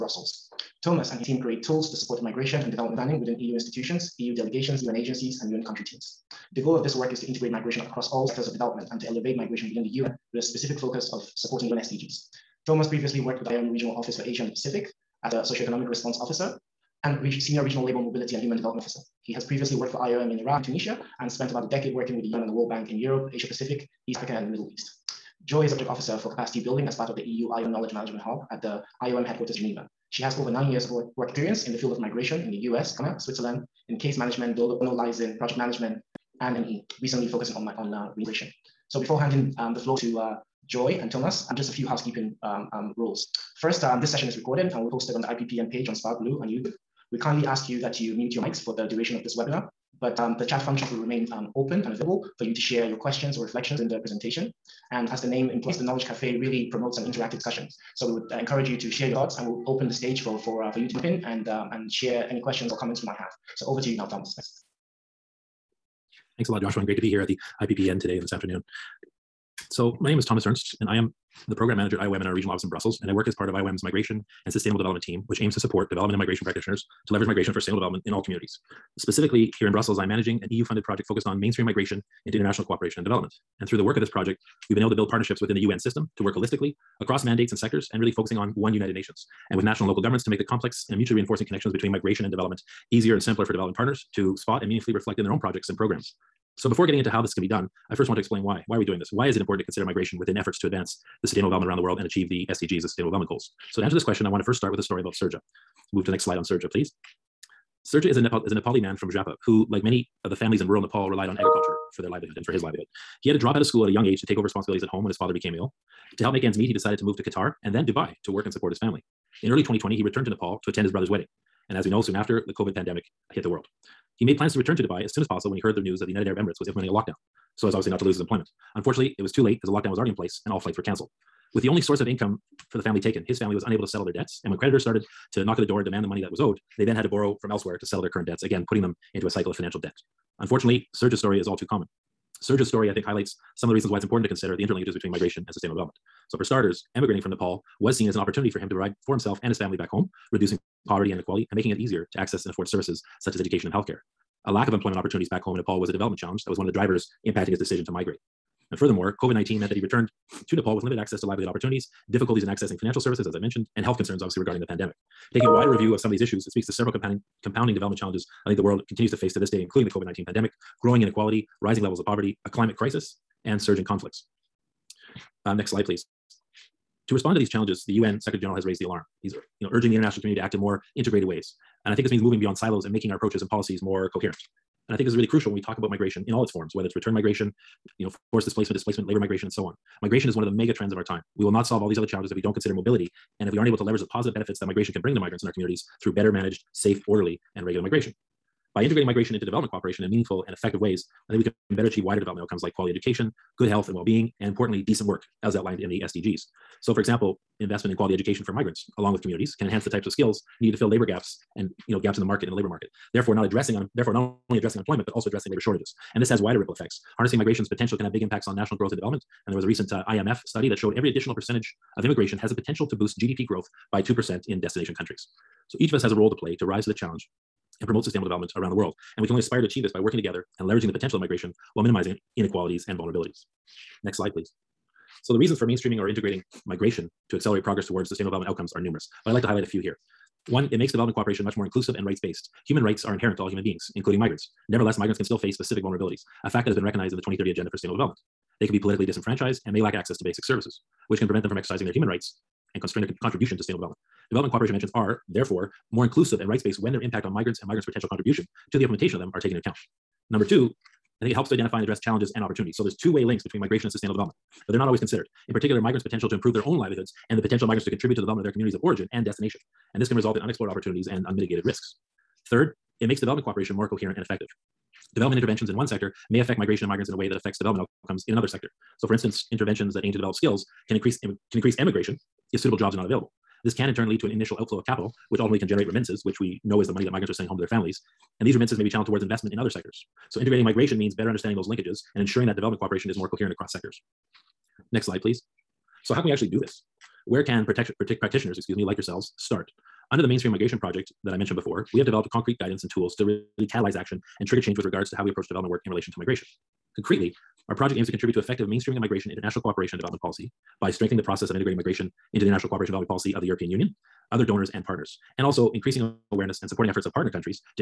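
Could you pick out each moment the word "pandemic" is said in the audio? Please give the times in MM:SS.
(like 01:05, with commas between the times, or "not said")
02:02, 02:44, 02:50.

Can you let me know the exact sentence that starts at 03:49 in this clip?
And we can only aspire to achieve this by working together and leveraging the potential of migration while minimizing inequalities and vulnerabilities.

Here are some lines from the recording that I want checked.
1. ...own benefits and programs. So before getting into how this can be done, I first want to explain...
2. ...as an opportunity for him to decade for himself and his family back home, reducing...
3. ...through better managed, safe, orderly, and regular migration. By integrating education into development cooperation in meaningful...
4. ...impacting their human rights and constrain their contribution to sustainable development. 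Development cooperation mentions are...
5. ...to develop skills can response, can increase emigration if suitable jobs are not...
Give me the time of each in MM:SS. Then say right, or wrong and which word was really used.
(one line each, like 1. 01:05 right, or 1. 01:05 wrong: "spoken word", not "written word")
1. 01:35 wrong: "projects", not "benefits"
2. 02:28 wrong: "provide", not "decade"
3. 03:16 wrong: "migration", not "education"
4. 04:11 wrong: "exercising", not "impacting"
5. 04:40 wrong: "increase", not "response".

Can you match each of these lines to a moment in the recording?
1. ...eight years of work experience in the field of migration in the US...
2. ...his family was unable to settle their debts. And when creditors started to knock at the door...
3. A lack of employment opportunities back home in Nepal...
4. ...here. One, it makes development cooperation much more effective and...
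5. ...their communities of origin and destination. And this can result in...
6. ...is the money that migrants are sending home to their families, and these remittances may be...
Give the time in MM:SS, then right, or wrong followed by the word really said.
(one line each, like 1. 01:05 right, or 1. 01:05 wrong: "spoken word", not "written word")
1. 00:30 wrong: "nine", not "eight"
2. 02:13 right
3. 02:34 right
4. 03:59 wrong: "inclusive", not "effective"
5. 04:28 right
6. 04:46 right.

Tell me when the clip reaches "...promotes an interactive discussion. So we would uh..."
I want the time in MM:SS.
00:56.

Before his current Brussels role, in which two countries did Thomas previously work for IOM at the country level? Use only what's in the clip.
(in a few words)
Iran and Tunisia.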